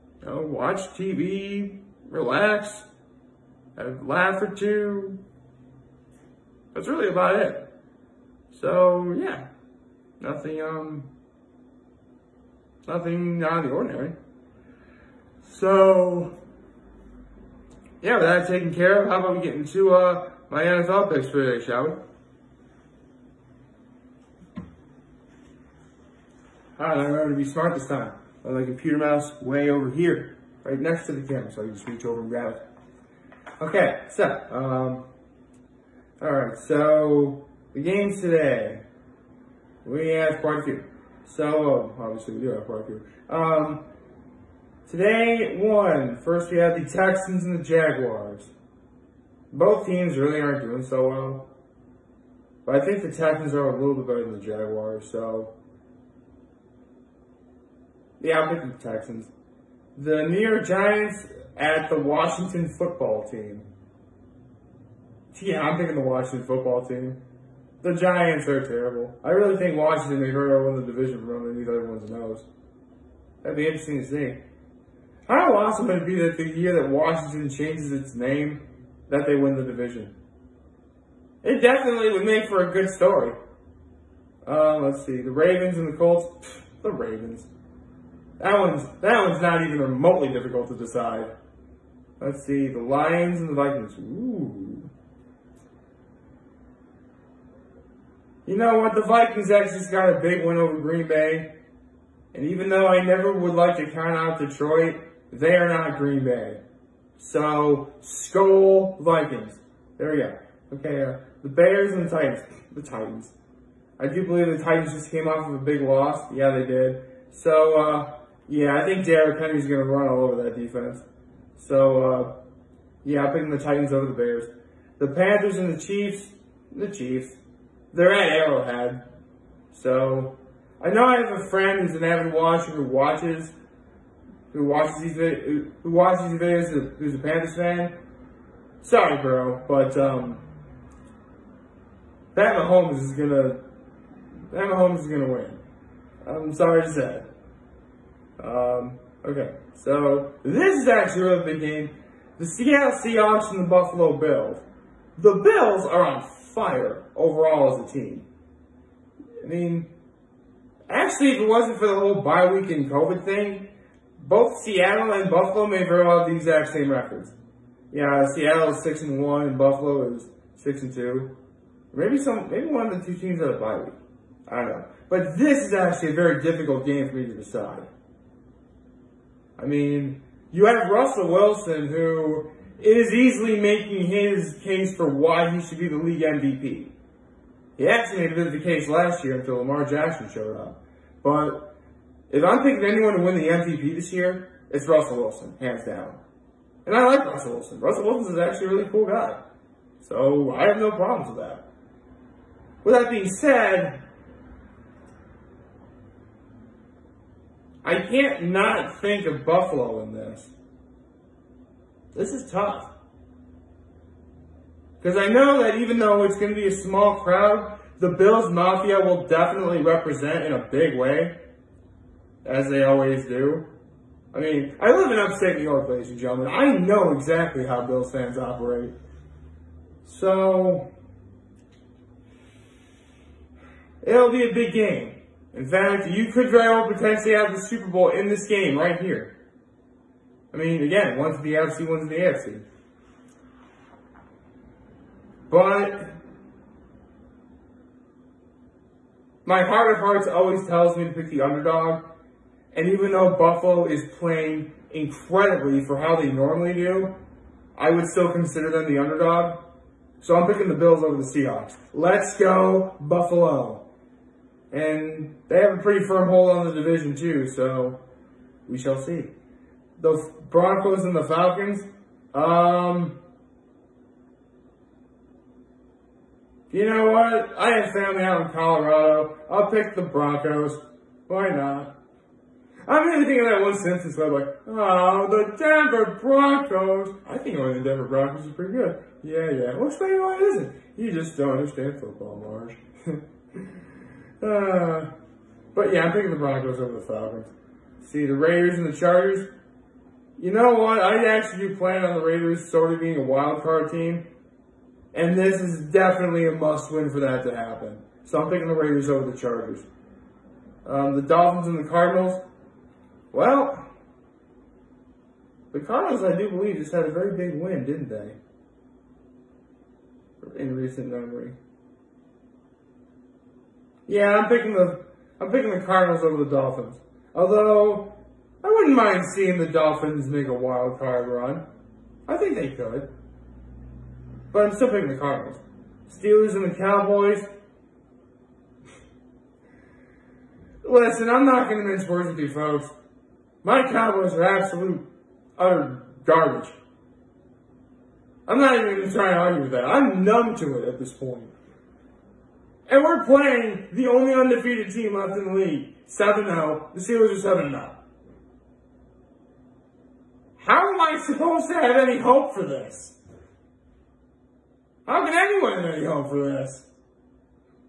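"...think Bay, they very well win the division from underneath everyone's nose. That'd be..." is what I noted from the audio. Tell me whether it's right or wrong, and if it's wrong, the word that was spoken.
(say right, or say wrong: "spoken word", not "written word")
wrong: "Washington", not "Bay".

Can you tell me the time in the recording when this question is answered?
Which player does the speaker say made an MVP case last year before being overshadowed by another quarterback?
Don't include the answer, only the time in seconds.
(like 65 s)
189 s.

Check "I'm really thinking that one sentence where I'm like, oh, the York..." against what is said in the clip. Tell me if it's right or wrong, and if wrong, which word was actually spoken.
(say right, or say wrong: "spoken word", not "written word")
wrong: "Denver", not "York".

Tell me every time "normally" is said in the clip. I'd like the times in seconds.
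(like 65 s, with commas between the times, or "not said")
256 s.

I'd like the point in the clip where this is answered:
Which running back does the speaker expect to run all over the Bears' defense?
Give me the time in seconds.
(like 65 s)
119 s.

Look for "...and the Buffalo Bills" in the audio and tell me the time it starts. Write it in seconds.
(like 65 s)
153 s.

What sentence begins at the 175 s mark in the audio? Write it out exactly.
But this is actually a very difficult game for me to decide.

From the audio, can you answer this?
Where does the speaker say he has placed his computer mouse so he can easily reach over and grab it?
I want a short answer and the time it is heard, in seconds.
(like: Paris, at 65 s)
Right next to the camera, at 30 s.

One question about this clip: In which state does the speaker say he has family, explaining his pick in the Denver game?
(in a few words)
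Colorado.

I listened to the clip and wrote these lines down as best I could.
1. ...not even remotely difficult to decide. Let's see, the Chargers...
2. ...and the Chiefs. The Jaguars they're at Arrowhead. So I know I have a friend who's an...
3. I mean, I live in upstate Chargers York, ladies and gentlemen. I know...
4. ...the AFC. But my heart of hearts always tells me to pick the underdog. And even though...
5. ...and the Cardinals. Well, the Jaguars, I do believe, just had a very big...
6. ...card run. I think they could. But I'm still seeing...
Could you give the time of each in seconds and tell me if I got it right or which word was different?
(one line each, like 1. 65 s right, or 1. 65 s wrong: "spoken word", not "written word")
1. 89 s wrong: "Lions", not "Chargers"
2. 125 s wrong: "Chiefs", not "Jaguars"
3. 224 s wrong: "New", not "Chargers"
4. 242 s right
5. 311 s wrong: "Cardinals", not "Jaguars"
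6. 330 s wrong: "picking", not "seeing".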